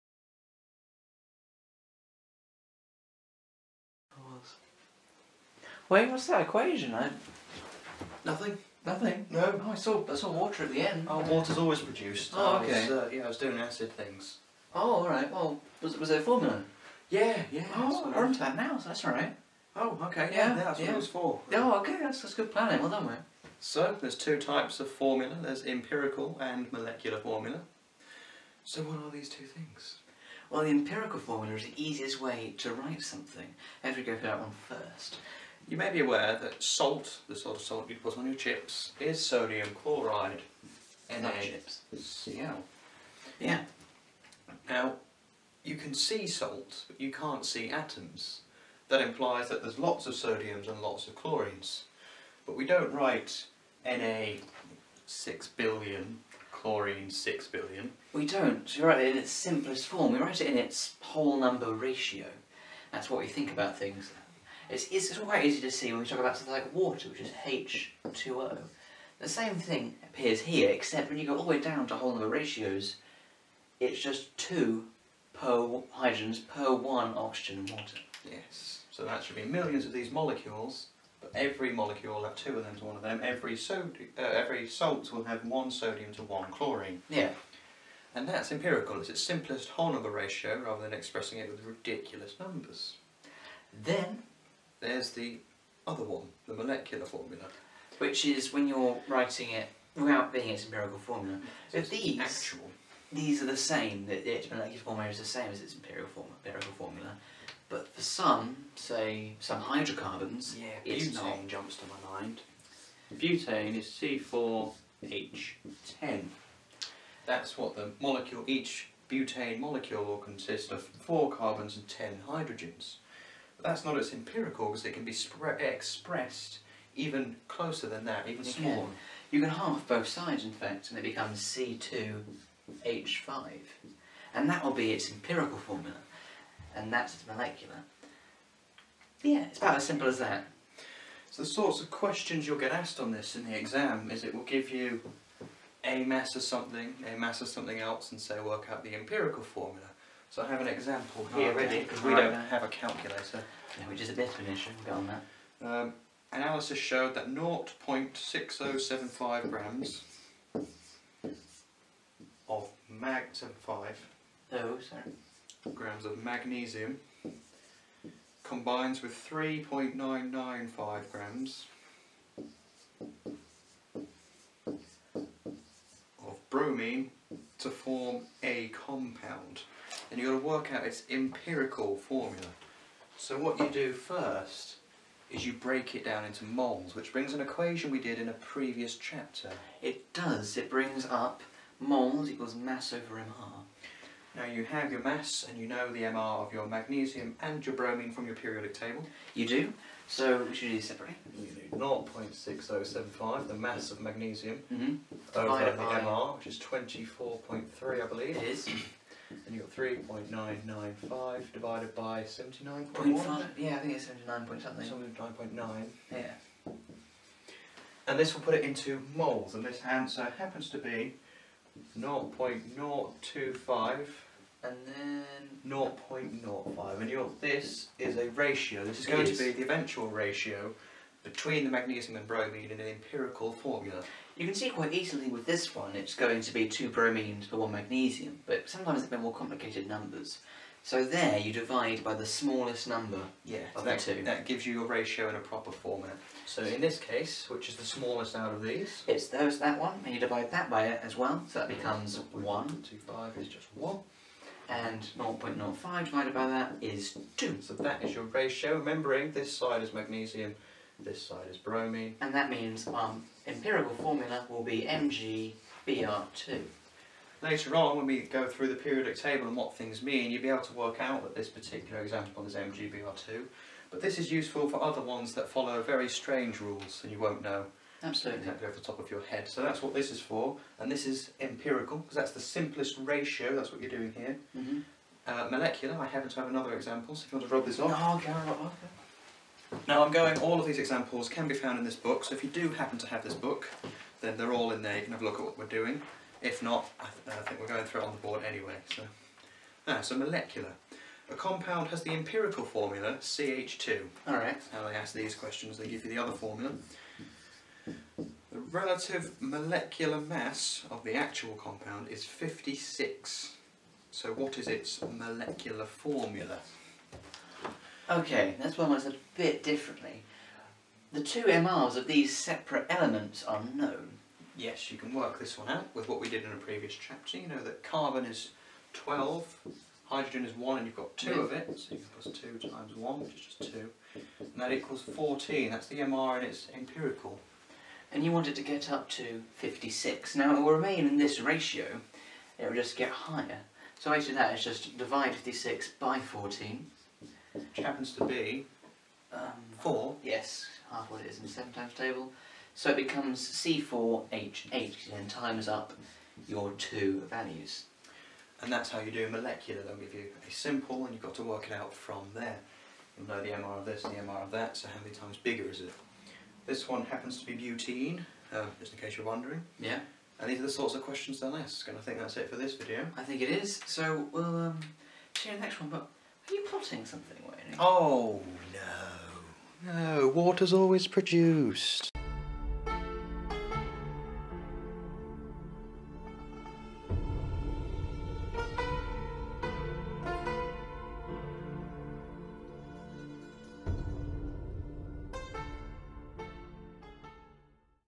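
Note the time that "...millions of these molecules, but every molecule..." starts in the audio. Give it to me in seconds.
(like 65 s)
79 s.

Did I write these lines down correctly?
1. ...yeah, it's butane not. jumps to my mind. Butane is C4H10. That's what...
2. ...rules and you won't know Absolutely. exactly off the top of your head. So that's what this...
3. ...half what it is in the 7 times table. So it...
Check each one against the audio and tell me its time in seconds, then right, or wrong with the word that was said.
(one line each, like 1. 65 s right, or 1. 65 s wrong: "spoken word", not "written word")
1. 110 s right
2. 276 s right
3. 350 s right.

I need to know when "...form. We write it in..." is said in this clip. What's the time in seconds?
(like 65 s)
59 s.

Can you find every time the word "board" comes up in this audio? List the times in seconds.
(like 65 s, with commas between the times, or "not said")
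298 s.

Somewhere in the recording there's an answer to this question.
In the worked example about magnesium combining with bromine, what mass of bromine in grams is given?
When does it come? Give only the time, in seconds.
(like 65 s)
169 s.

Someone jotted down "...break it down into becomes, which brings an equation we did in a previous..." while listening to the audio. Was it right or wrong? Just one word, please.
wrong.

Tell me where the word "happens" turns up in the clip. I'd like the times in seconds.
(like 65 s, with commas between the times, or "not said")
220 s, 286 s, 292 s, 347 s, 367 s.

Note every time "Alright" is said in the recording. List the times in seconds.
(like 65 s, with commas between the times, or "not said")
304 s.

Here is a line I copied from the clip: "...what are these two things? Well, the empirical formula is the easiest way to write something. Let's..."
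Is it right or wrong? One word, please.
right.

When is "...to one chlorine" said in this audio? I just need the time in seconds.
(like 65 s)
86 s.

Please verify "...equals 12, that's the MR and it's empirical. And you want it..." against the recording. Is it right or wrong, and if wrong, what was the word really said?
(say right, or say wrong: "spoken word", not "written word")
wrong: "14", not "12".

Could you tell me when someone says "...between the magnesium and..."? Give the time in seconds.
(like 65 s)
231 s.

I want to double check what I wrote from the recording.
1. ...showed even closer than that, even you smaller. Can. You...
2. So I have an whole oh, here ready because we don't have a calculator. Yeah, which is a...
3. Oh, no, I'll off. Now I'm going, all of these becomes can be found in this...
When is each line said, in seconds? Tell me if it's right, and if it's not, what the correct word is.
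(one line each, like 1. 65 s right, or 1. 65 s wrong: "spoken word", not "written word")
1. 125 s wrong: "expressed", not "showed"
2. 150 s wrong: "example", not "whole"
3. 287 s wrong: "examples", not "becomes".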